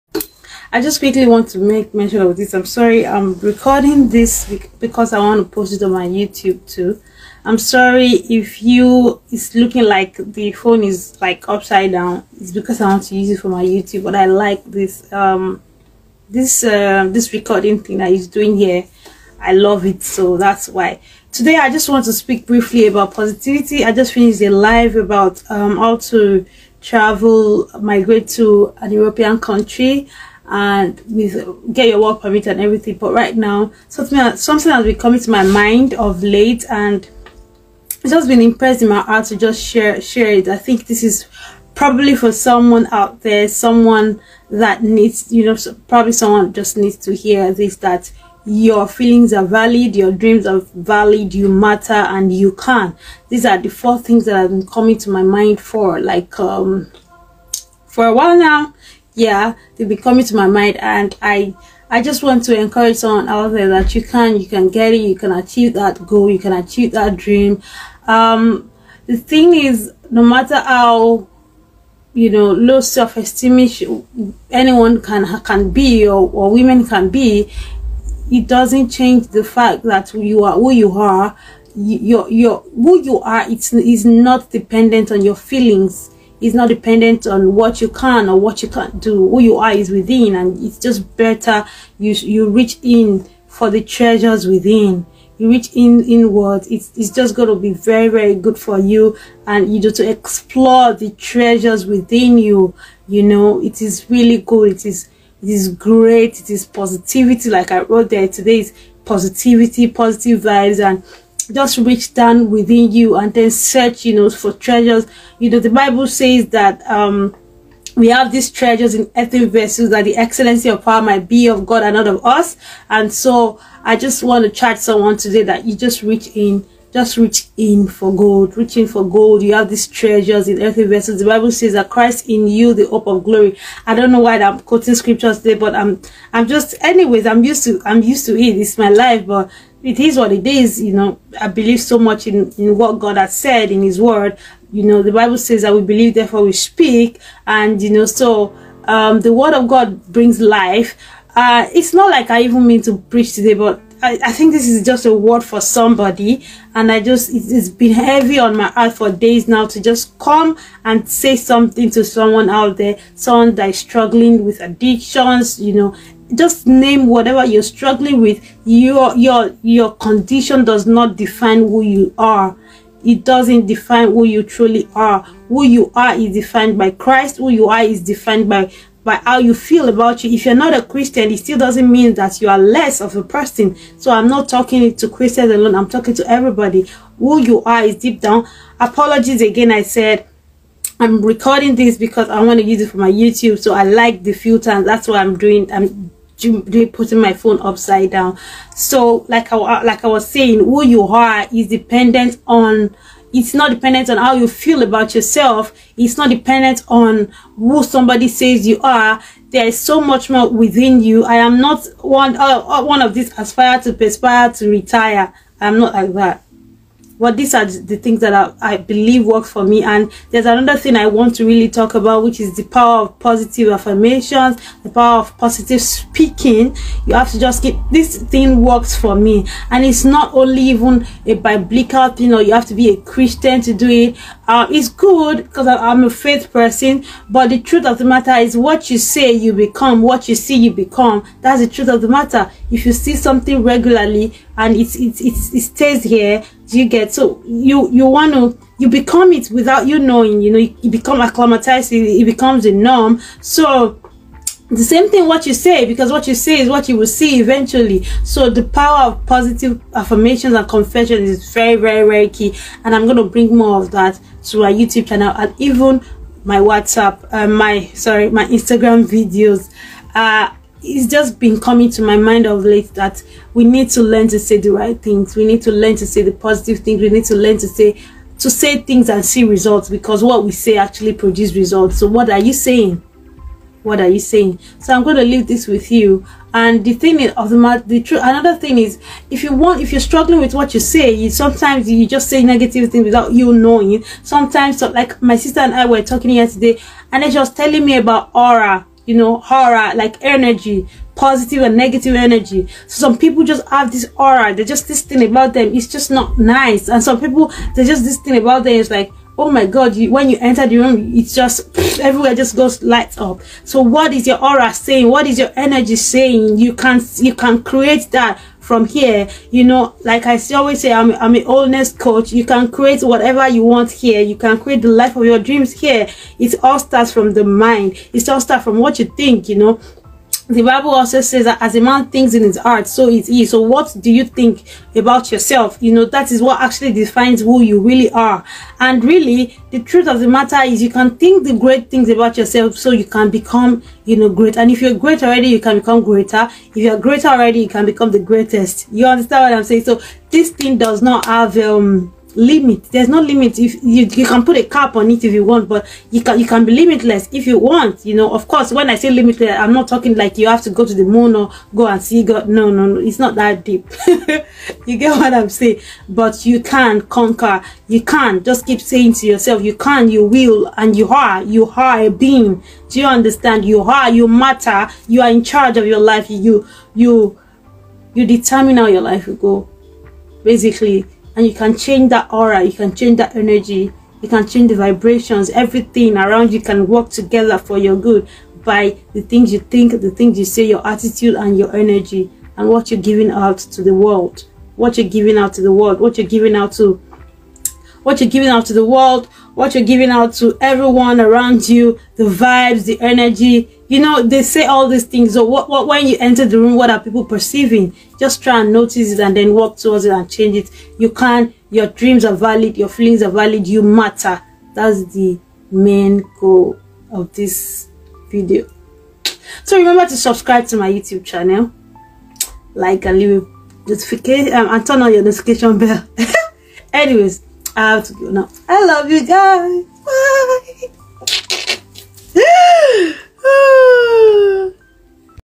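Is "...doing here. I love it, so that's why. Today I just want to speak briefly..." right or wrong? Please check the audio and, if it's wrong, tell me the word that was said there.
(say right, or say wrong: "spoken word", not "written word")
right.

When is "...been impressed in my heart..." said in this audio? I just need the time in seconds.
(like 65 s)
38 s.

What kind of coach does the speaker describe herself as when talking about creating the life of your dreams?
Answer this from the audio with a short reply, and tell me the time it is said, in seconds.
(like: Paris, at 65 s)
wellness coach, at 321 s.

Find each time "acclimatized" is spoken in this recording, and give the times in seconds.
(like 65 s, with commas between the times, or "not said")
251 s.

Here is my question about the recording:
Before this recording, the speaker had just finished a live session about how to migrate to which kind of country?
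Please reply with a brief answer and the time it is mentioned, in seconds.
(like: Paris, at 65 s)
European country, at 28 s.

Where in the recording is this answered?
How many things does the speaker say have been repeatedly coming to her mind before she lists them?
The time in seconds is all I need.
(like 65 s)
53 s.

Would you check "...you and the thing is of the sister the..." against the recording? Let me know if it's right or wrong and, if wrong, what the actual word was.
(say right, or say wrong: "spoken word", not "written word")
wrong: "matter", not "sister".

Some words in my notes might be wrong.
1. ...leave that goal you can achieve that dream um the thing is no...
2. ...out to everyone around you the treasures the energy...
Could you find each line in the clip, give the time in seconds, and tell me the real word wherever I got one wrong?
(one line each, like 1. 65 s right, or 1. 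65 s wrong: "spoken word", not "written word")
1. 65 s wrong: "achieve", not "leave"
2. 400 s wrong: "vibes", not "treasures".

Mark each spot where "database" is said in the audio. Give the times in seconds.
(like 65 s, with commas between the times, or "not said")
not said.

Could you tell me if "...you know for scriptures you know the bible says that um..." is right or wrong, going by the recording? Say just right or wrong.
wrong.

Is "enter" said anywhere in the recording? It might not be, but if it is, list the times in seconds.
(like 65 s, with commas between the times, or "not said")
310 s, 406 s.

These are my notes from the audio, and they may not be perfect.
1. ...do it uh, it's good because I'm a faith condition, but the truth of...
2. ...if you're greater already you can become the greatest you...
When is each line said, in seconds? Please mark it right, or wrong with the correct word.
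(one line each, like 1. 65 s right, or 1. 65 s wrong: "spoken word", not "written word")
1. 233 s wrong: "person", not "condition"
2. 346 s right.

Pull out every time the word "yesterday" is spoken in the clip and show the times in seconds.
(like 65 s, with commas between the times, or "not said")
296 s.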